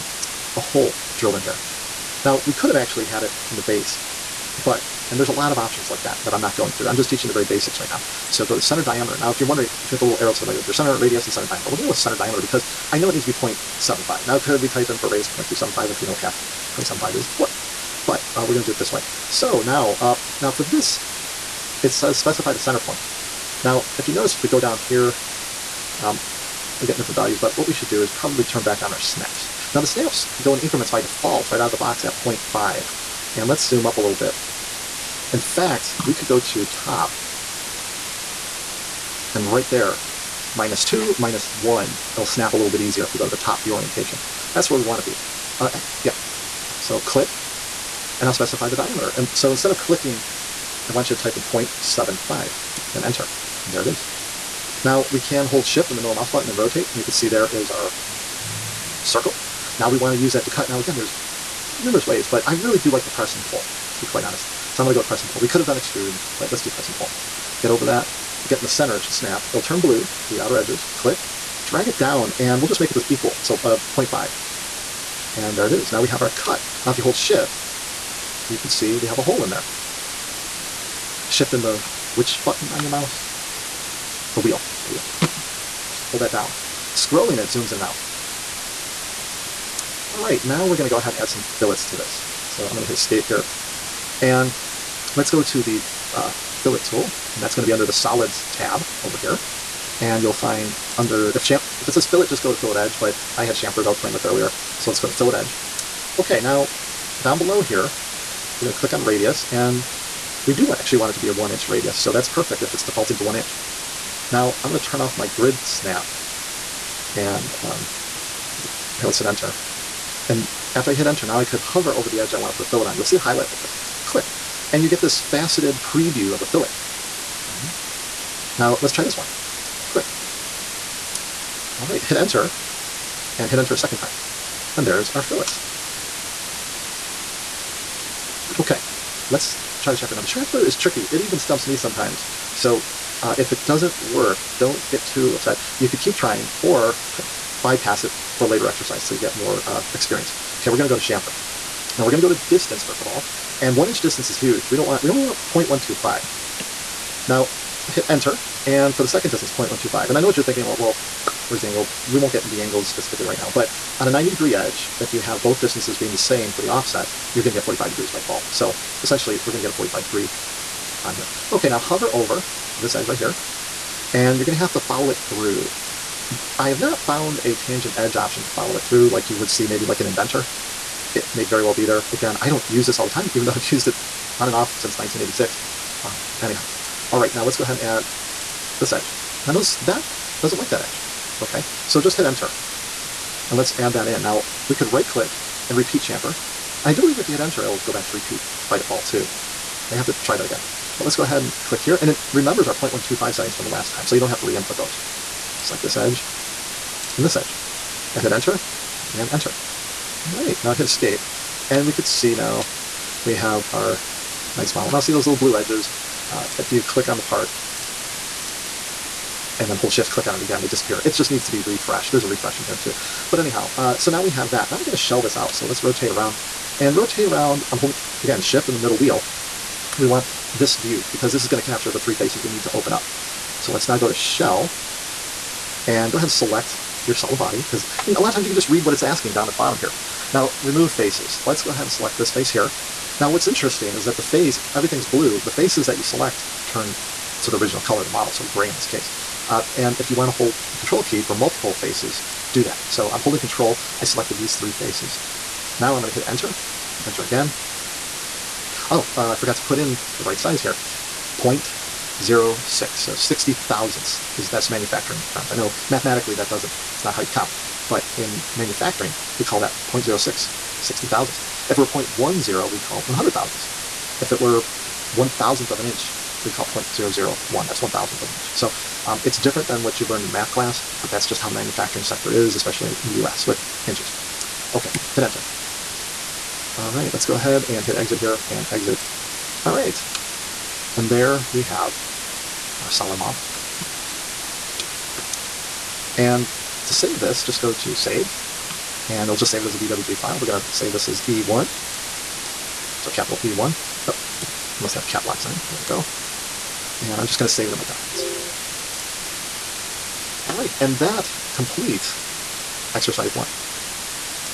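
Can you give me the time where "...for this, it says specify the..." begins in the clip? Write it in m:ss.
0:20.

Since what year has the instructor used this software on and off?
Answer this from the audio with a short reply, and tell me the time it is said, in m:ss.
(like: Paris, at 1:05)
1986, at 3:04.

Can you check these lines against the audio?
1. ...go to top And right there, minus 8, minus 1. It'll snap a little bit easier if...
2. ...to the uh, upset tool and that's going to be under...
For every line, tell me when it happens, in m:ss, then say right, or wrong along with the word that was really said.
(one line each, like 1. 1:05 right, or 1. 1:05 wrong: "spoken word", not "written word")
1. 0:36 wrong: "2", not "8"
2. 1:35 wrong: "fillet", not "upset".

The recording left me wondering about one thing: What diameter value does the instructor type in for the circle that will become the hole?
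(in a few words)
0.75.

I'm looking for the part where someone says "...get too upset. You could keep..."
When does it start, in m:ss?
2:24.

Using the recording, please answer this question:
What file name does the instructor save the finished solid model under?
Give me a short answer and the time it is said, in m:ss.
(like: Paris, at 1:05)
E1, at 5:03.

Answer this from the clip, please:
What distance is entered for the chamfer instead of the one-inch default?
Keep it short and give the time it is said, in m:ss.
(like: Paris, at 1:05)
0.125, at 2:34.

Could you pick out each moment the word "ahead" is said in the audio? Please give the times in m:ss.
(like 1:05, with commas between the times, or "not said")
1:30, 3:07, 3:21, 3:56, 4:01, 4:47.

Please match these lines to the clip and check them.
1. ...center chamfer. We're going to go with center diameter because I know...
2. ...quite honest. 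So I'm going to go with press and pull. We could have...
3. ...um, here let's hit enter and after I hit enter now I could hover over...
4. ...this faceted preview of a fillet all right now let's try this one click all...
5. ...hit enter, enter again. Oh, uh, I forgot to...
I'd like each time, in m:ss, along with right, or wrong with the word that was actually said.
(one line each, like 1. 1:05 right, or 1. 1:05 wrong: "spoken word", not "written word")
1. 0:11 wrong: "diameter", not "chamfer"
2. 1:04 right
3. 1:57 right
4. 2:05 right
5. 4:16 right.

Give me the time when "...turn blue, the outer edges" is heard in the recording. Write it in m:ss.
1:09.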